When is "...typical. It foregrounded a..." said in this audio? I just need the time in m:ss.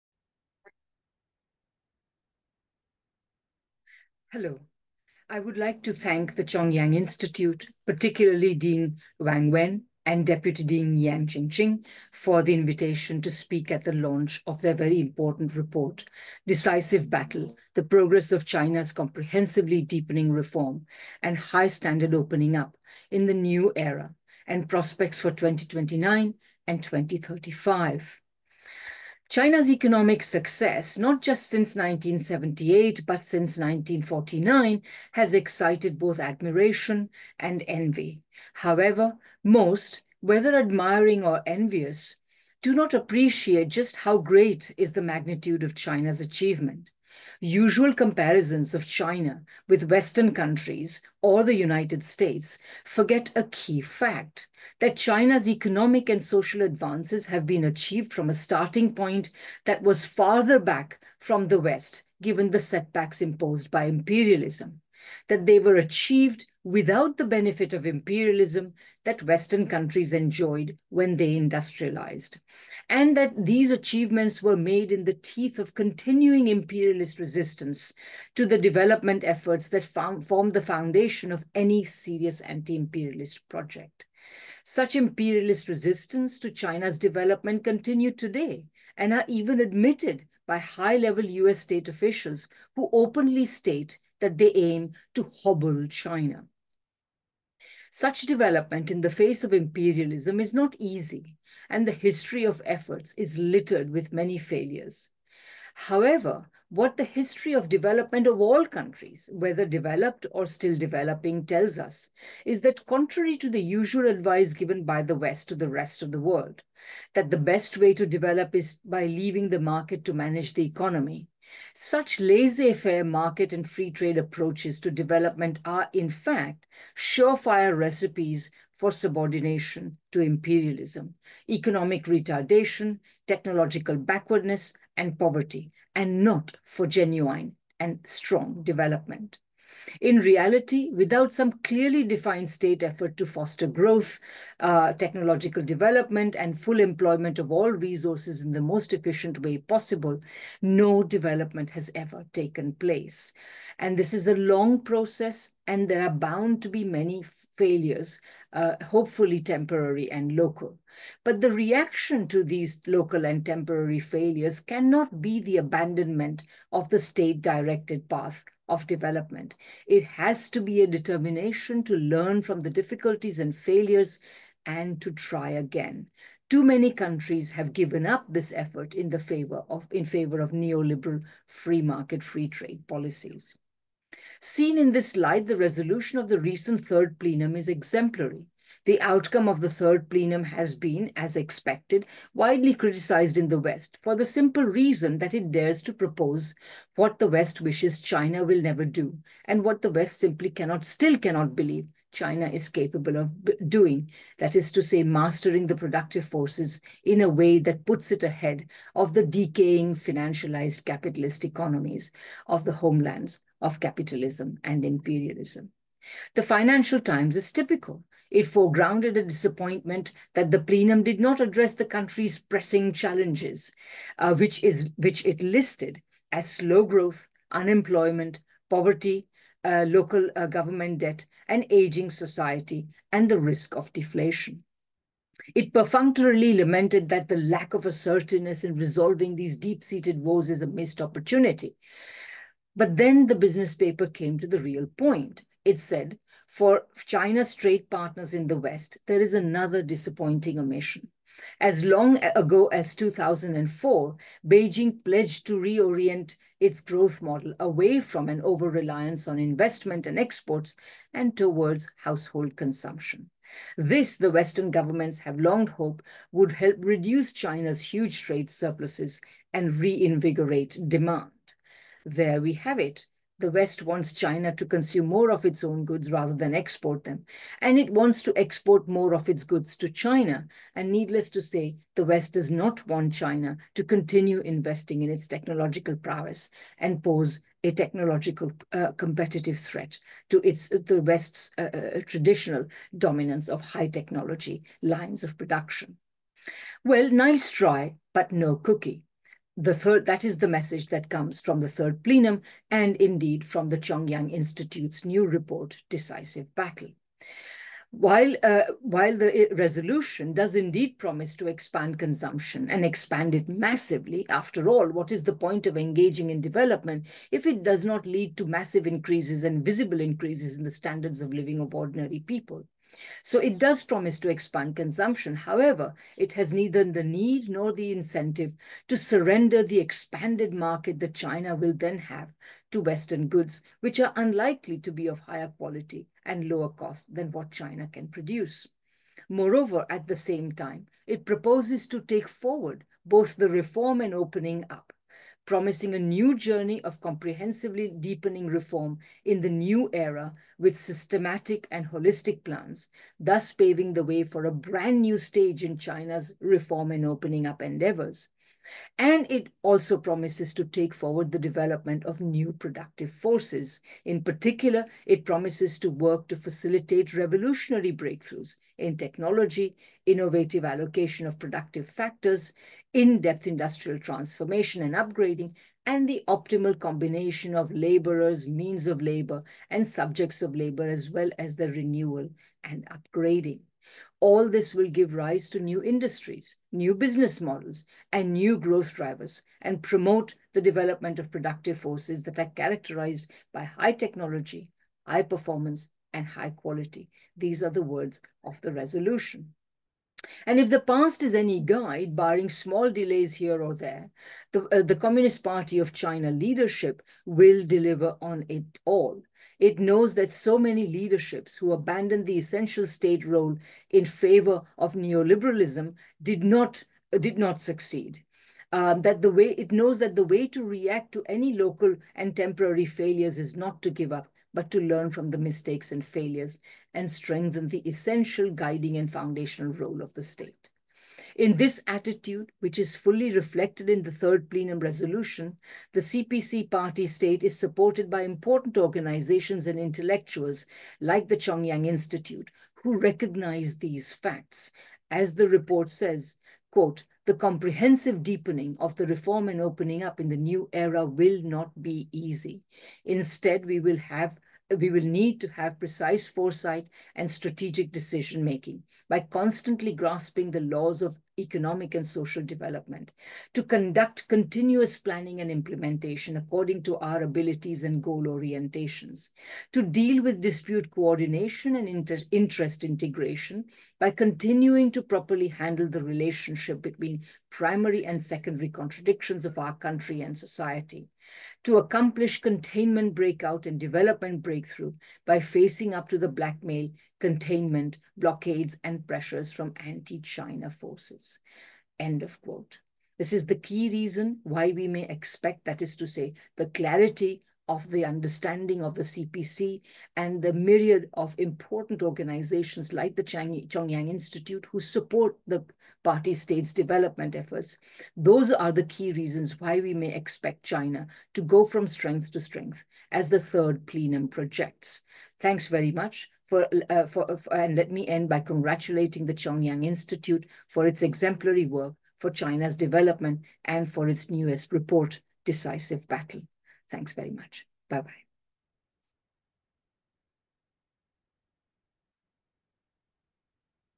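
3:37.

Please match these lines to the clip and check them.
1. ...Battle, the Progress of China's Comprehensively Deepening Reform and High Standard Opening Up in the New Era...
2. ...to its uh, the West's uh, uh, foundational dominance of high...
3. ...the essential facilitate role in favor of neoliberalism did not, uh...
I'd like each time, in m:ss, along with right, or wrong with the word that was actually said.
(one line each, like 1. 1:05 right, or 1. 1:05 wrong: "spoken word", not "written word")
1. 0:17 right
2. 4:50 wrong: "traditional", not "foundational"
3. 6:52 wrong: "state", not "facilitate".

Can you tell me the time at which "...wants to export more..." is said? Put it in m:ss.
4:37.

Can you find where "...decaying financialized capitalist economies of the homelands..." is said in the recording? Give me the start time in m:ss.
3:29.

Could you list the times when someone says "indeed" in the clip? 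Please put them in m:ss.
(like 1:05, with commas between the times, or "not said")
5:02, 5:10.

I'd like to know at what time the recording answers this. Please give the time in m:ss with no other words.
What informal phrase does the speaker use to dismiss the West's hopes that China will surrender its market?
4:57.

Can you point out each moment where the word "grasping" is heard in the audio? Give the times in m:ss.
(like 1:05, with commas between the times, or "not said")
7:39.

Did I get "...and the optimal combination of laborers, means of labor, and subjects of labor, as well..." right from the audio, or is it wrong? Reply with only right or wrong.
right.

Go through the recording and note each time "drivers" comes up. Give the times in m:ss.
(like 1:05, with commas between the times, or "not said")
6:28.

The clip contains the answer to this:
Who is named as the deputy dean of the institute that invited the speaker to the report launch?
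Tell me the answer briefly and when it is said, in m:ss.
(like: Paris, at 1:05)
Yang Qingqing, at 0:10.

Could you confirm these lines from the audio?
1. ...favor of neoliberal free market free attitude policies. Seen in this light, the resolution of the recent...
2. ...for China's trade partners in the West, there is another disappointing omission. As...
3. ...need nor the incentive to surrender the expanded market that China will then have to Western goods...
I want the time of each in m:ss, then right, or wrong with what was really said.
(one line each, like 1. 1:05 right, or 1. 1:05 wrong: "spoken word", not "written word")
1. 3:00 wrong: "trade", not "attitude"
2. 4:06 right
3. 5:27 right.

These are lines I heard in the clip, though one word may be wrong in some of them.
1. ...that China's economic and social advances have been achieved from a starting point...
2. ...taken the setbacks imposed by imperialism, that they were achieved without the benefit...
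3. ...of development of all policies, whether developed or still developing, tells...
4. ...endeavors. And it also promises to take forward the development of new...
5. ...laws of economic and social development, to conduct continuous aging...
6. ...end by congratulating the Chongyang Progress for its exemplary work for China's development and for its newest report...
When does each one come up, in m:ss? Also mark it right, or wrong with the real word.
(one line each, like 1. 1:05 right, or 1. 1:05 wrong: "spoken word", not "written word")
1. 0:54 right
2. 1:02 wrong: "given", not "taken"
3. 1:47 wrong: "countries", not "policies"
4. 5:57 right
5. 7:40 wrong: "planning", not "aging"
6. 8:38 wrong: "Institute", not "Progress".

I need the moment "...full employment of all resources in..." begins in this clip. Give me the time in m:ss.
2:26.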